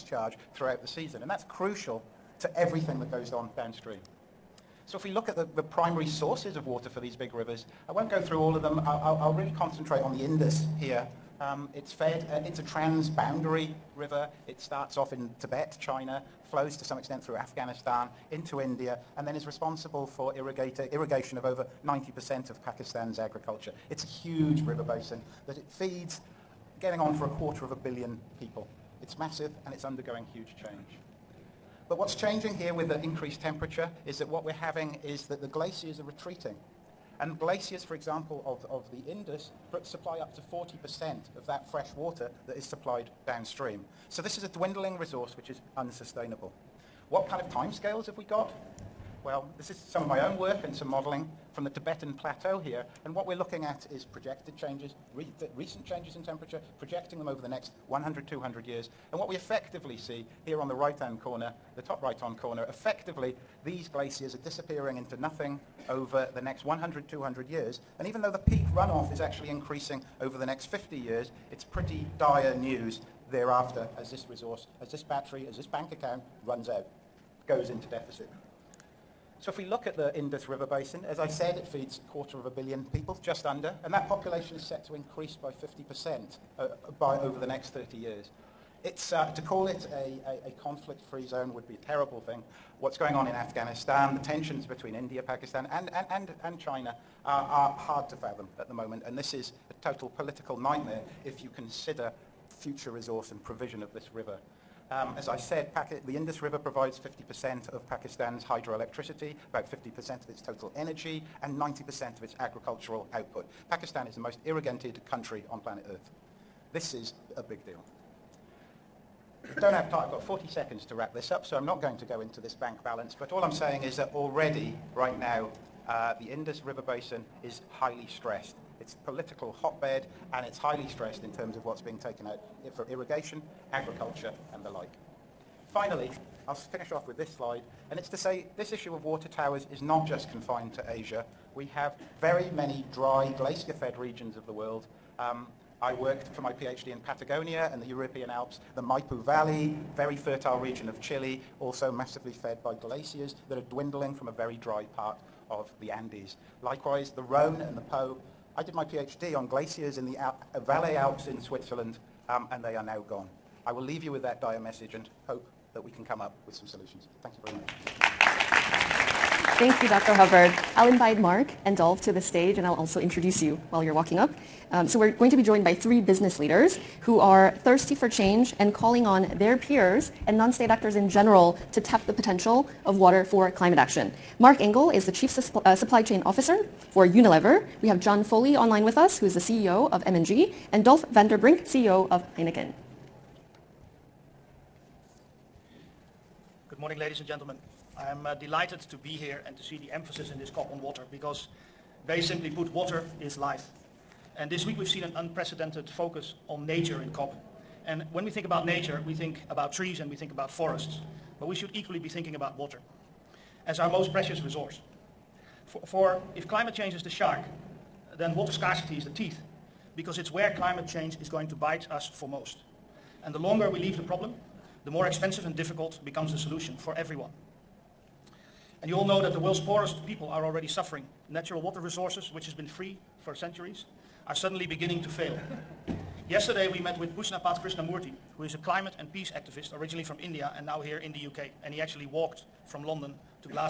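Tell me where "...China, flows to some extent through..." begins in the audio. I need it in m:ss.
0:15.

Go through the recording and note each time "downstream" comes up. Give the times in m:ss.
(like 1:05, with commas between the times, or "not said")
0:03, 0:43.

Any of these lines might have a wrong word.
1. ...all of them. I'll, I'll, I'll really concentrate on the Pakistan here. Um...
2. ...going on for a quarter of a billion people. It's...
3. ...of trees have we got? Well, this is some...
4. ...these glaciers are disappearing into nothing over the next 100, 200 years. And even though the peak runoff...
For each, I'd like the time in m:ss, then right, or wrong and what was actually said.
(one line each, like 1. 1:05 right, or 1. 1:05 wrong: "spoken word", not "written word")
1. 0:08 wrong: "Indus", not "Pakistan"
2. 0:26 right
3. 0:47 wrong: "timescales", not "trees"
4. 1:03 right.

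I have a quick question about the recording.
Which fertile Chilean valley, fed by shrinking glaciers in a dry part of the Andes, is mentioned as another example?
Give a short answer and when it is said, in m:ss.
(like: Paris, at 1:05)
Maipo Valley, at 2:28.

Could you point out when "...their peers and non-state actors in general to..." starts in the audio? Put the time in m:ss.
2:59.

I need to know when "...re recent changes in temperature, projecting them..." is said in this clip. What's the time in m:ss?
0:55.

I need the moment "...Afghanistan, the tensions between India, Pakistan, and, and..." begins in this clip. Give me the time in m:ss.
1:33.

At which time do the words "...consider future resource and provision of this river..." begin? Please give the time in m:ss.
1:41.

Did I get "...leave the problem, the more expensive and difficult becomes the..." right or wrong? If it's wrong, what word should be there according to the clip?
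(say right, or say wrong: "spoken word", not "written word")
right.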